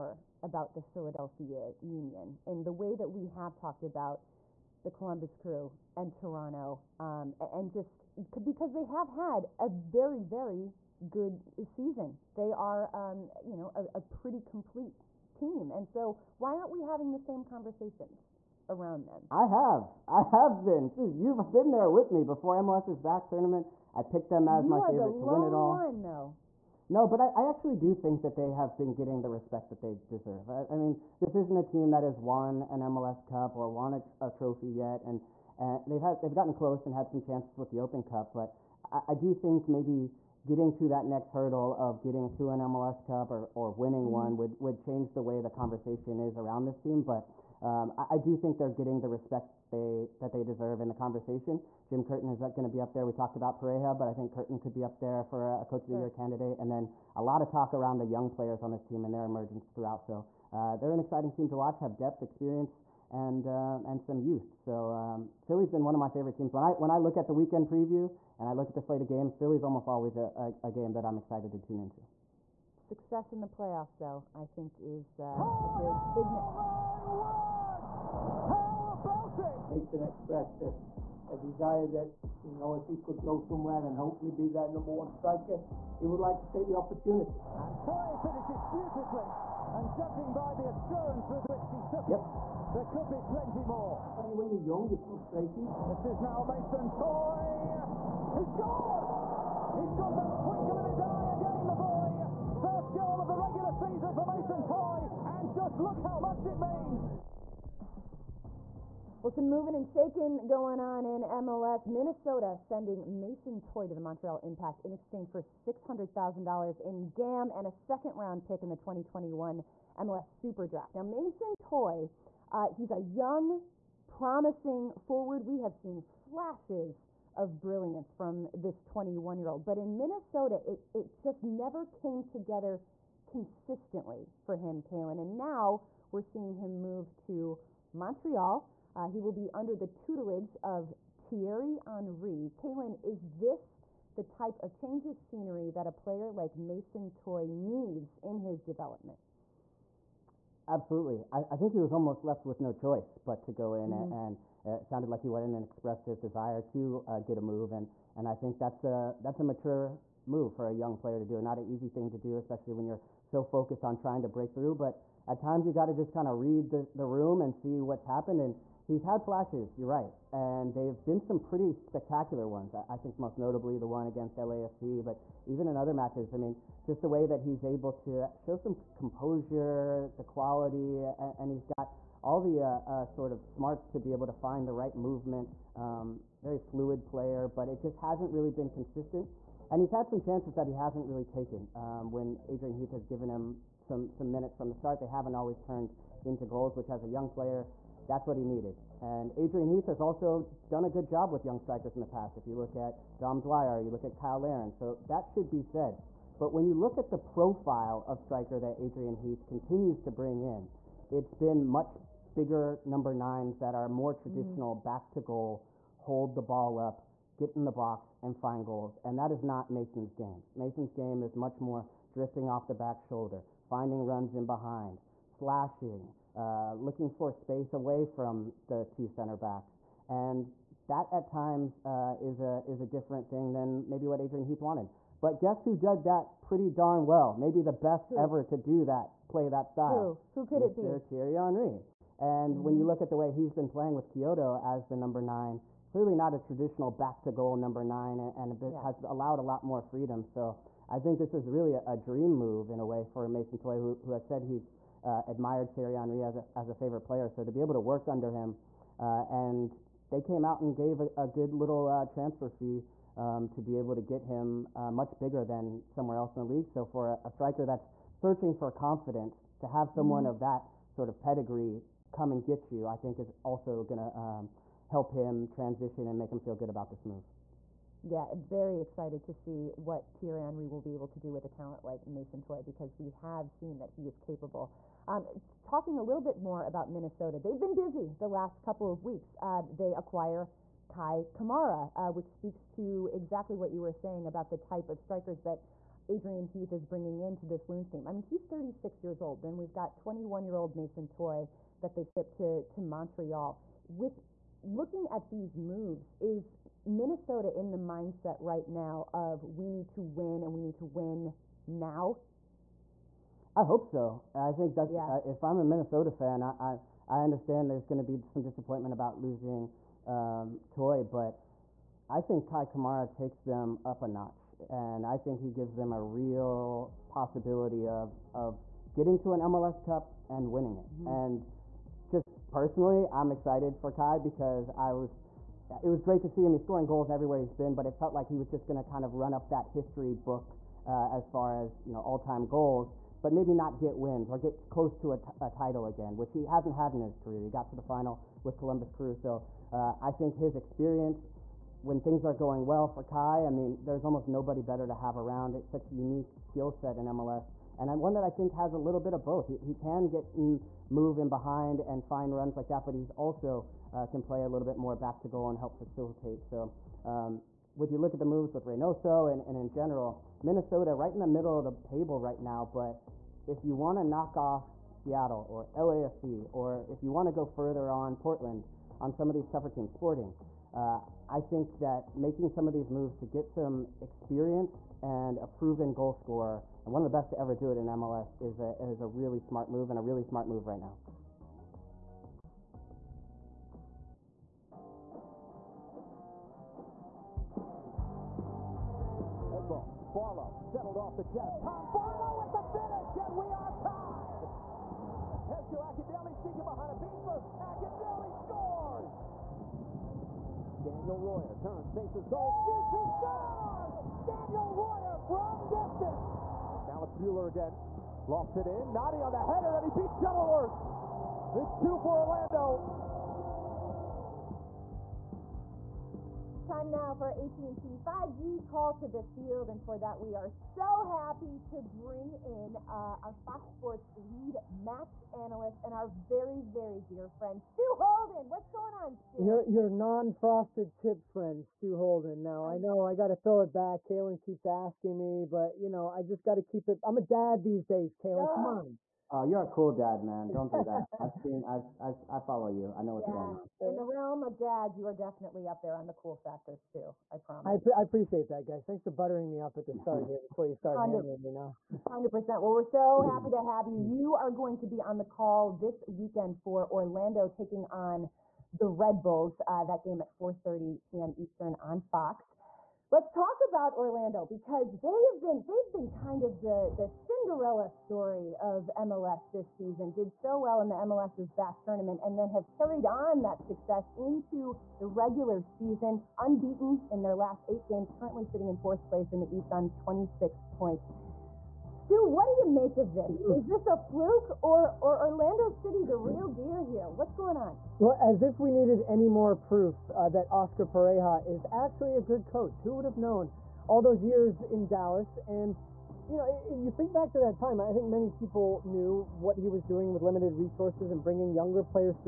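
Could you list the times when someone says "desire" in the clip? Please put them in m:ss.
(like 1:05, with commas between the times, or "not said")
1:21, 2:36.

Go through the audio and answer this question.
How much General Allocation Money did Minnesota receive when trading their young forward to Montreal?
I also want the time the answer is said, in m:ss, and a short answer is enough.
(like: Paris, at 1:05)
$600,000, at 1:55.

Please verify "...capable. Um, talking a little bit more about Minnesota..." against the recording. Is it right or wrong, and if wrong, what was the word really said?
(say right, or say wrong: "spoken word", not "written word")
right.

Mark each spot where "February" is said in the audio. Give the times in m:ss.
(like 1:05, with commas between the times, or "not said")
not said.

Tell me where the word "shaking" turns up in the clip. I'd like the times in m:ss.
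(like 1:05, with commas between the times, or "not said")
1:49.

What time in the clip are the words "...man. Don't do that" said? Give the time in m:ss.
7:30.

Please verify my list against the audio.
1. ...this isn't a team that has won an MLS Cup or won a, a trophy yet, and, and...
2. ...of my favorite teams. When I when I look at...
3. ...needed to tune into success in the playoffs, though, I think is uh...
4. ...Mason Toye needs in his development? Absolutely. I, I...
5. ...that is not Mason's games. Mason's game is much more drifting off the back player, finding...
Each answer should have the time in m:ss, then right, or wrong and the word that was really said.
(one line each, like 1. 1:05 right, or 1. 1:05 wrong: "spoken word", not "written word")
1. 0:31 right
2. 1:05 right
3. 1:11 wrong: "excited", not "needed"
4. 2:26 right
5. 3:39 wrong: "shoulder", not "player".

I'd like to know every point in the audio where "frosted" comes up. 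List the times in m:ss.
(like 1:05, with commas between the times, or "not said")
7:19.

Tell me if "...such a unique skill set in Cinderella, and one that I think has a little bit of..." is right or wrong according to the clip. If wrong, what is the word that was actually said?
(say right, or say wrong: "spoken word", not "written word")
wrong: "MLS", not "Cinderella".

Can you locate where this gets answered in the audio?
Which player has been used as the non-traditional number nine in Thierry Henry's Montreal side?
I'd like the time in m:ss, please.
4:04.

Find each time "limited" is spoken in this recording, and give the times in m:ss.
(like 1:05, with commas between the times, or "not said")
8:30.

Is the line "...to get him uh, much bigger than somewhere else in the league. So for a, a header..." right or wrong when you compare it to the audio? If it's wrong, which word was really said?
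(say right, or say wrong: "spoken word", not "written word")
wrong: "striker", not "header".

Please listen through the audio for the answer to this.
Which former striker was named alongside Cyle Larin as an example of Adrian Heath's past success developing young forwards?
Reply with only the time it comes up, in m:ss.
3:23.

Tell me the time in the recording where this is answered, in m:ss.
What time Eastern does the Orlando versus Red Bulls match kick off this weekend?
7:50.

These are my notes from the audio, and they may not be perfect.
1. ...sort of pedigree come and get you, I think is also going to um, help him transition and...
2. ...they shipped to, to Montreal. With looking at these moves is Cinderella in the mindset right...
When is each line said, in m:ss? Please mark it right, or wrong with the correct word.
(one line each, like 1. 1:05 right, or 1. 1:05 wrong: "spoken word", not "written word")
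1. 4:30 right
2. 5:01 wrong: "Minnesota", not "Cinderella".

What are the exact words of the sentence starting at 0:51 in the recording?
Jim Curtin is going to be up there.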